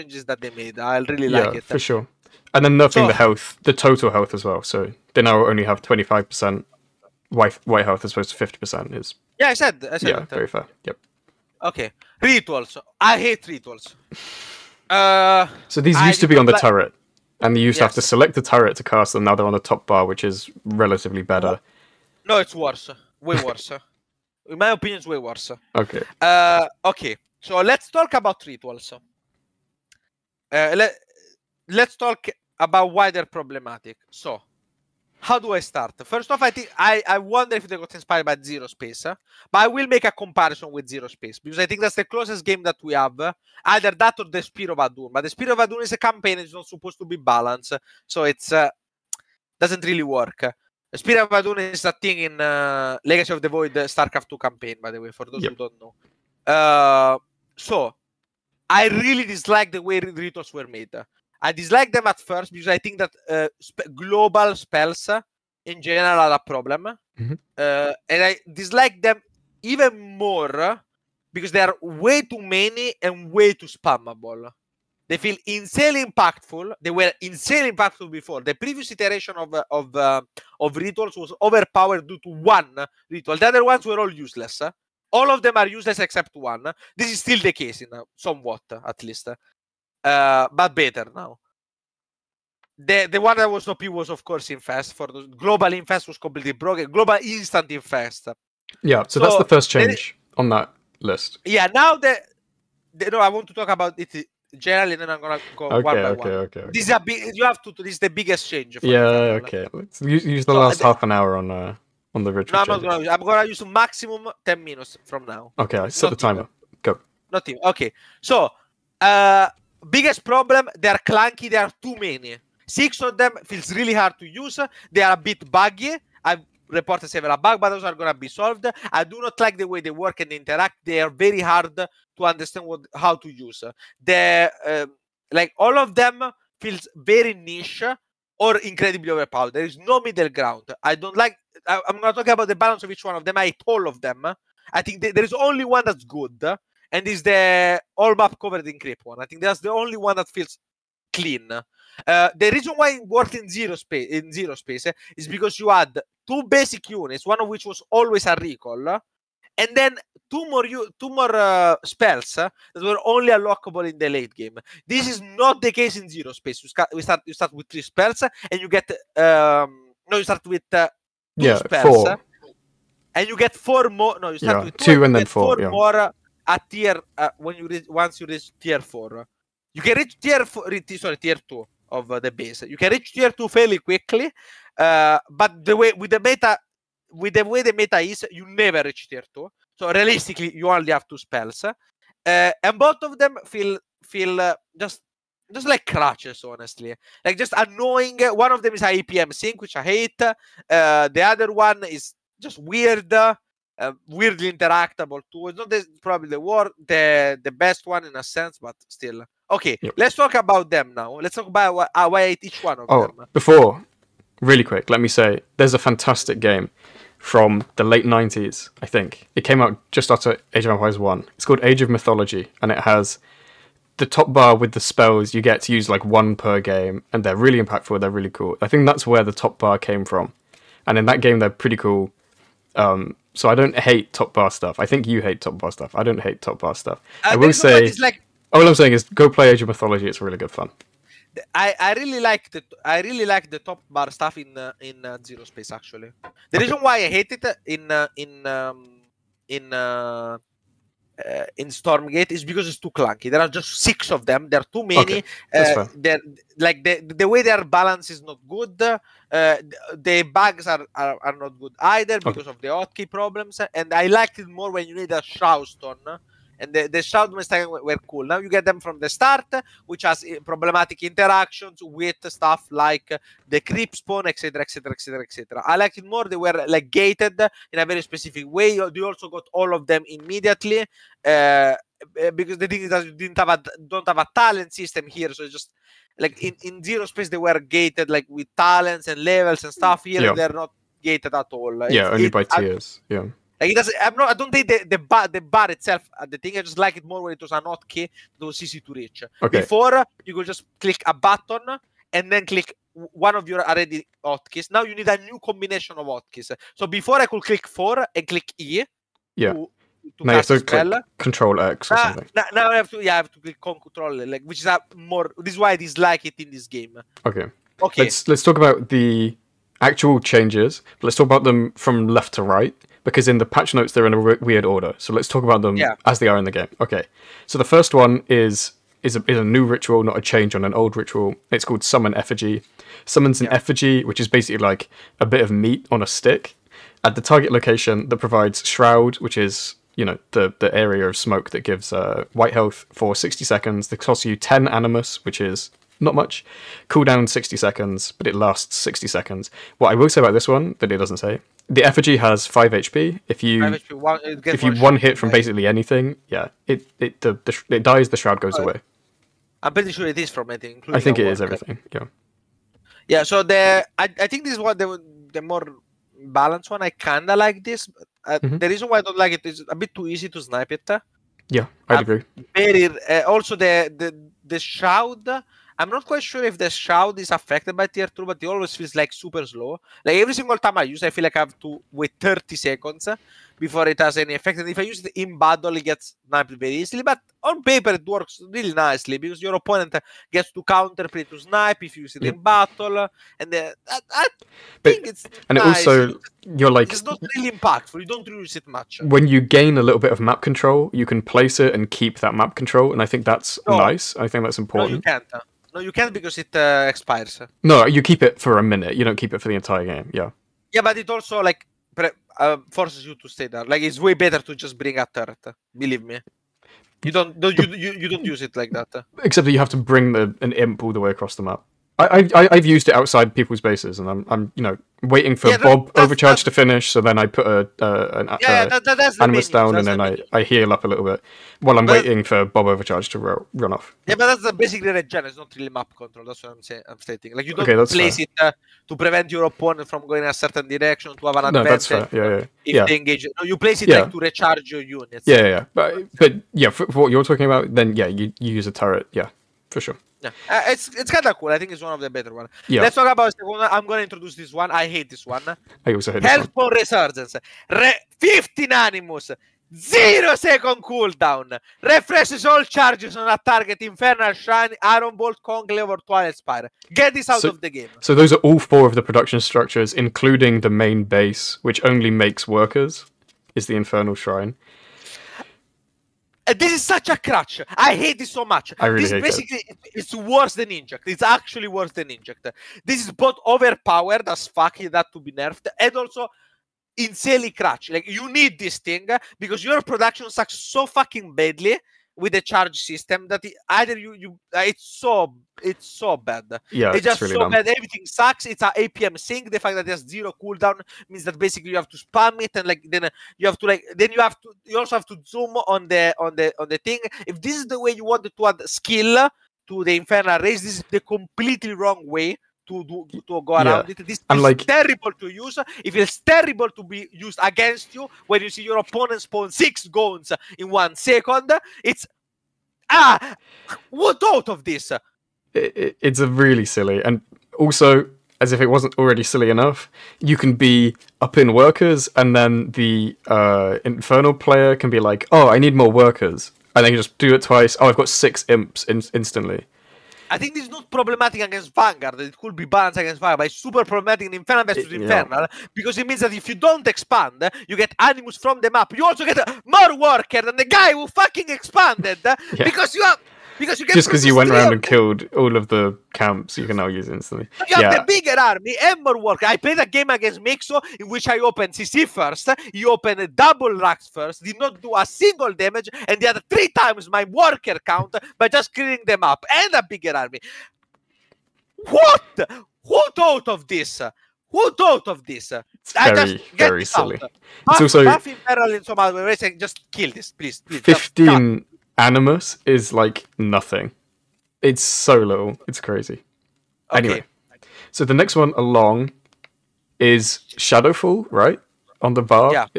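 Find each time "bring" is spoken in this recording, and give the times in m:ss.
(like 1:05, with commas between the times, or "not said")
6:54, 6:59.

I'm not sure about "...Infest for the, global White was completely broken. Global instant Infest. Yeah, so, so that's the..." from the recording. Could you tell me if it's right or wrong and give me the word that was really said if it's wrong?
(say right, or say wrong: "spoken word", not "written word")
wrong: "Infest", not "White".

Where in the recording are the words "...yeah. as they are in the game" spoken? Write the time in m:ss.
5:25.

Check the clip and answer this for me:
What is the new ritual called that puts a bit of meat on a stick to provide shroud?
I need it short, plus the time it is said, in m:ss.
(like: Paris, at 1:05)
Summon Effigy, at 5:31.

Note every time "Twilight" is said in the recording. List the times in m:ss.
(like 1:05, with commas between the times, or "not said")
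7:45.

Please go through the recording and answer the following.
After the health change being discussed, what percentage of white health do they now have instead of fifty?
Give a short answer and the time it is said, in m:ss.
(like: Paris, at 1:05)
25 percent, at 0:05.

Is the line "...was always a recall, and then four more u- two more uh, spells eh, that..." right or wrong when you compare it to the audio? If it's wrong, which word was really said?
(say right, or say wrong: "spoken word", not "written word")
wrong: "two", not "four".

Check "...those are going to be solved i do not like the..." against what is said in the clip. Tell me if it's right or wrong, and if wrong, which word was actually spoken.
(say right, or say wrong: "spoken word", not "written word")
right.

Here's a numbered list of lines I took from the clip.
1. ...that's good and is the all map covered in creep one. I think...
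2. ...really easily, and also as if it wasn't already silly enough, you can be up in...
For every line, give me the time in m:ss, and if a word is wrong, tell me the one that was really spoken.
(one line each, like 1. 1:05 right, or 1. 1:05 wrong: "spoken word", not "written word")
1. 2:25 right
2. 8:46 wrong: "silly", not "easily".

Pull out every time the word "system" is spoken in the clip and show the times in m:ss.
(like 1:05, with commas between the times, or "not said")
4:44, 8:12.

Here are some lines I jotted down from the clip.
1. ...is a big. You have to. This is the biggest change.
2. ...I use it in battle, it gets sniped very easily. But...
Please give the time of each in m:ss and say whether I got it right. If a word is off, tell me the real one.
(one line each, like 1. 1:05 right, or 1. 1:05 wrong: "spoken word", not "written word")
1. 1:46 right
2. 6:24 right.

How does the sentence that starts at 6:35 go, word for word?
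also you're like it's not really impactful.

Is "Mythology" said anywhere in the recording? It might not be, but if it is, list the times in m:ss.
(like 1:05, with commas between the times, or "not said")
3:41, 3:59.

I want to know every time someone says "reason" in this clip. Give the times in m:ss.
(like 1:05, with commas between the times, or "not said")
2:32, 4:06, 6:08.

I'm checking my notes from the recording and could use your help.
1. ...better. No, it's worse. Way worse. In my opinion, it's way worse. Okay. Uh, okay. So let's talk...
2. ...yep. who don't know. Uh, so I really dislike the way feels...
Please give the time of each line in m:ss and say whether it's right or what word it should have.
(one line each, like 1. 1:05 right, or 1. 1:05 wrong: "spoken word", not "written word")
1. 0:21 right
2. 0:55 wrong: "rituals", not "feels".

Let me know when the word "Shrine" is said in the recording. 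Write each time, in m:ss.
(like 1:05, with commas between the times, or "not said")
7:44, 7:54.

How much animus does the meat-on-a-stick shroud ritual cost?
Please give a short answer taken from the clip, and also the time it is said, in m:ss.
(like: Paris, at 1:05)
10, at 5:44.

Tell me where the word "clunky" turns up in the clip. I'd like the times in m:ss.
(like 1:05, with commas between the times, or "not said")
2:00, 4:12.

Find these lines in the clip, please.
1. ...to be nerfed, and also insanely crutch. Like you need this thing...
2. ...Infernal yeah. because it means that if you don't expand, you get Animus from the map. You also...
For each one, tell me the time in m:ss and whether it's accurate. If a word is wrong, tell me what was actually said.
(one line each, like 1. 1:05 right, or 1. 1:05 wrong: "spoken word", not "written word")
1. 8:05 right
2. 9:04 right.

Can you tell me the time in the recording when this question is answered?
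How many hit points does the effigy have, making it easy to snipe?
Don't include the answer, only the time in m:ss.
5:52.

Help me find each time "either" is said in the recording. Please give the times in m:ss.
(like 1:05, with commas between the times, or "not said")
0:43, 4:21, 8:13.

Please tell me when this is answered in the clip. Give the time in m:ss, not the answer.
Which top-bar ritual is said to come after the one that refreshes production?
9:50.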